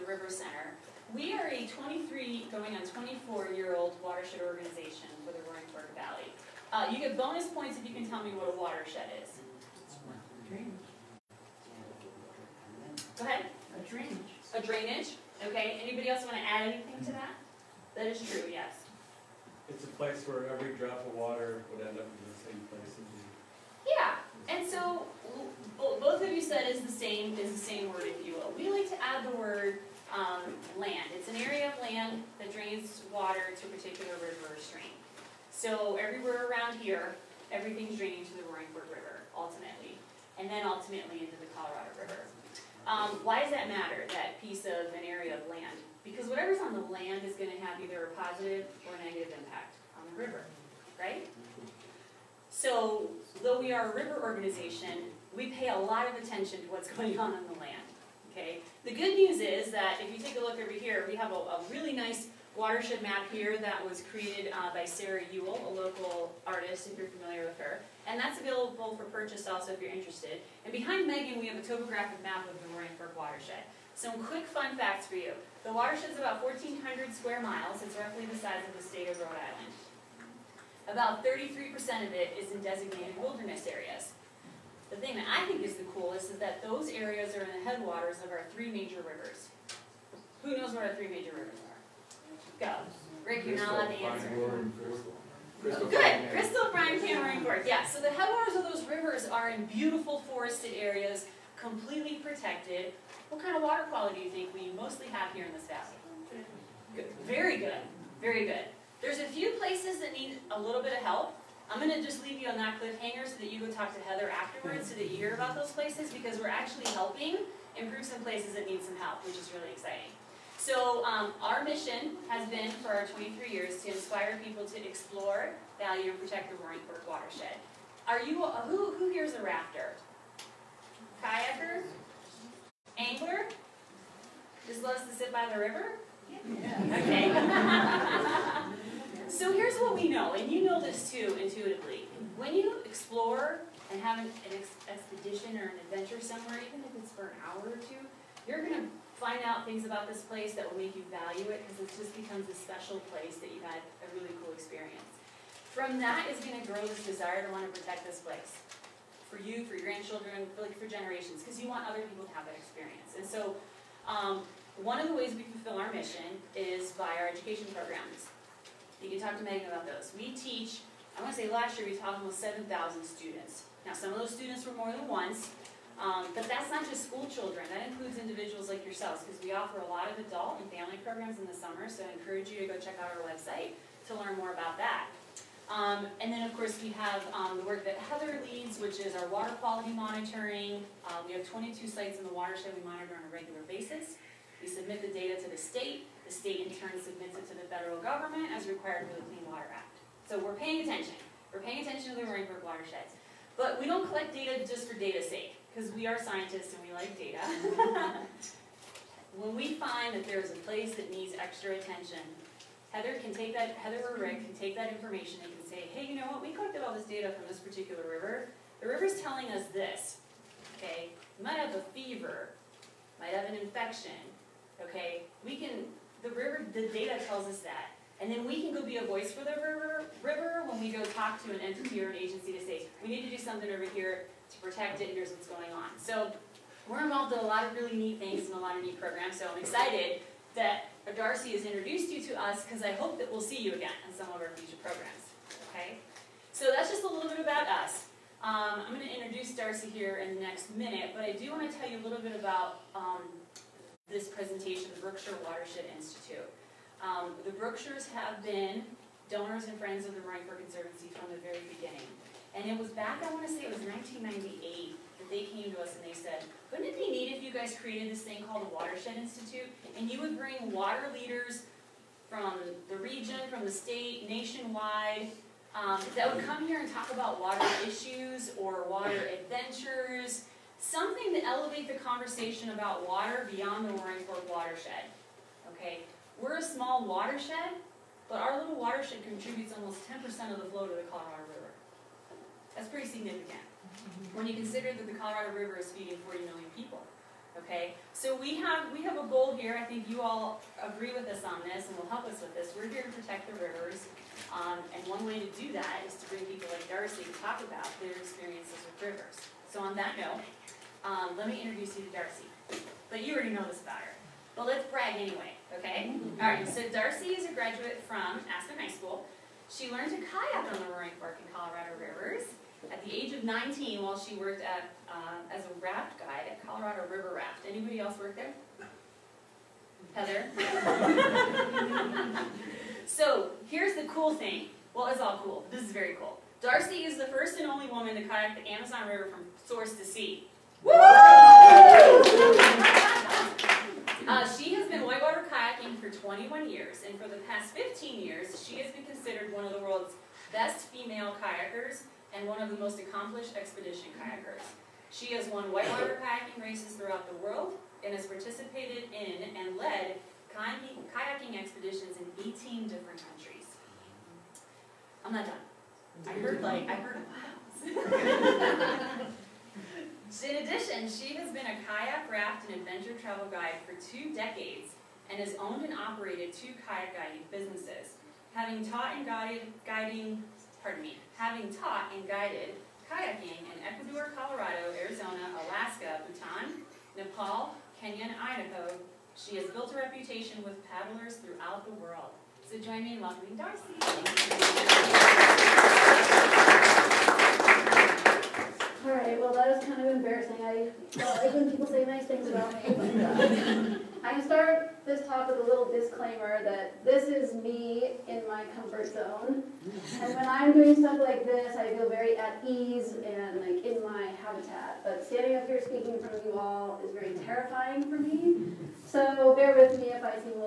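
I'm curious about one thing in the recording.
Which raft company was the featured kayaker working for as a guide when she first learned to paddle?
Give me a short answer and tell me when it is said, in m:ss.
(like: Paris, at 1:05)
Colorado River Raft, at 5:26.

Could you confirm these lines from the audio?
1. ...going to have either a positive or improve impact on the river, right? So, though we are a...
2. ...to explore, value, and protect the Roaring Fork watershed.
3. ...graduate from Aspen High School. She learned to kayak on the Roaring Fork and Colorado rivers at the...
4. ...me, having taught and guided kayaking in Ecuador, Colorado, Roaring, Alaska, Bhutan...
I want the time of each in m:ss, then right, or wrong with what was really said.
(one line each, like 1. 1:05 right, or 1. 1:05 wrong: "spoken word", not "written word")
1. 0:47 wrong: "negative", not "improve"
2. 2:04 right
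3. 5:17 right
4. 6:21 wrong: "Arizona", not "Roaring".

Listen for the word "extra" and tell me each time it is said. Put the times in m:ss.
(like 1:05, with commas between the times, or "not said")
3:31.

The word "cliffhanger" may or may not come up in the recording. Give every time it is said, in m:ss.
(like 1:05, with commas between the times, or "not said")
1:52.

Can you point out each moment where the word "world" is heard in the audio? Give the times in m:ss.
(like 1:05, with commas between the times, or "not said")
5:49, 5:57, 6:31.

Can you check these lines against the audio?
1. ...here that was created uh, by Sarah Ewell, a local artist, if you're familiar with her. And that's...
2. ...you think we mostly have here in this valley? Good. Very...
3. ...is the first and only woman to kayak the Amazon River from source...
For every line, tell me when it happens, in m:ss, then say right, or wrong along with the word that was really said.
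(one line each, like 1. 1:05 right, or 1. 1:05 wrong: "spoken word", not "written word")
1. 1:03 right
2. 1:44 right
3. 5:37 right.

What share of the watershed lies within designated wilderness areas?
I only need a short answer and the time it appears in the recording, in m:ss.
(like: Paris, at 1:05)
33%, at 1:21.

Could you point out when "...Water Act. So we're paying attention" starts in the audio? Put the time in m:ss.
3:19.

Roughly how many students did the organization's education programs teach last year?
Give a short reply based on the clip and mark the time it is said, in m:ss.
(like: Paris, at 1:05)
7,000, at 2:52.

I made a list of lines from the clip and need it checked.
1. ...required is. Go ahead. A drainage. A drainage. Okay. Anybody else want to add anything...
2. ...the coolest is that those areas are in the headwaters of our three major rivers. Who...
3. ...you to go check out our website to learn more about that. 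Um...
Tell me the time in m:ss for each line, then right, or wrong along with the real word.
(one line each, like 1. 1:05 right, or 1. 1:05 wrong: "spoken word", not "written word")
1. 0:08 wrong: "watershed", not "required"
2. 1:25 right
3. 3:02 right.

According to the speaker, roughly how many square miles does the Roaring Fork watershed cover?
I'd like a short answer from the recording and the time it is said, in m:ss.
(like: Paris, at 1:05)
1,400 square miles, at 1:16.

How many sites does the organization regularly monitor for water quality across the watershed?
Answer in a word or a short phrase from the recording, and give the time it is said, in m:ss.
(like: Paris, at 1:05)
22, at 3:11.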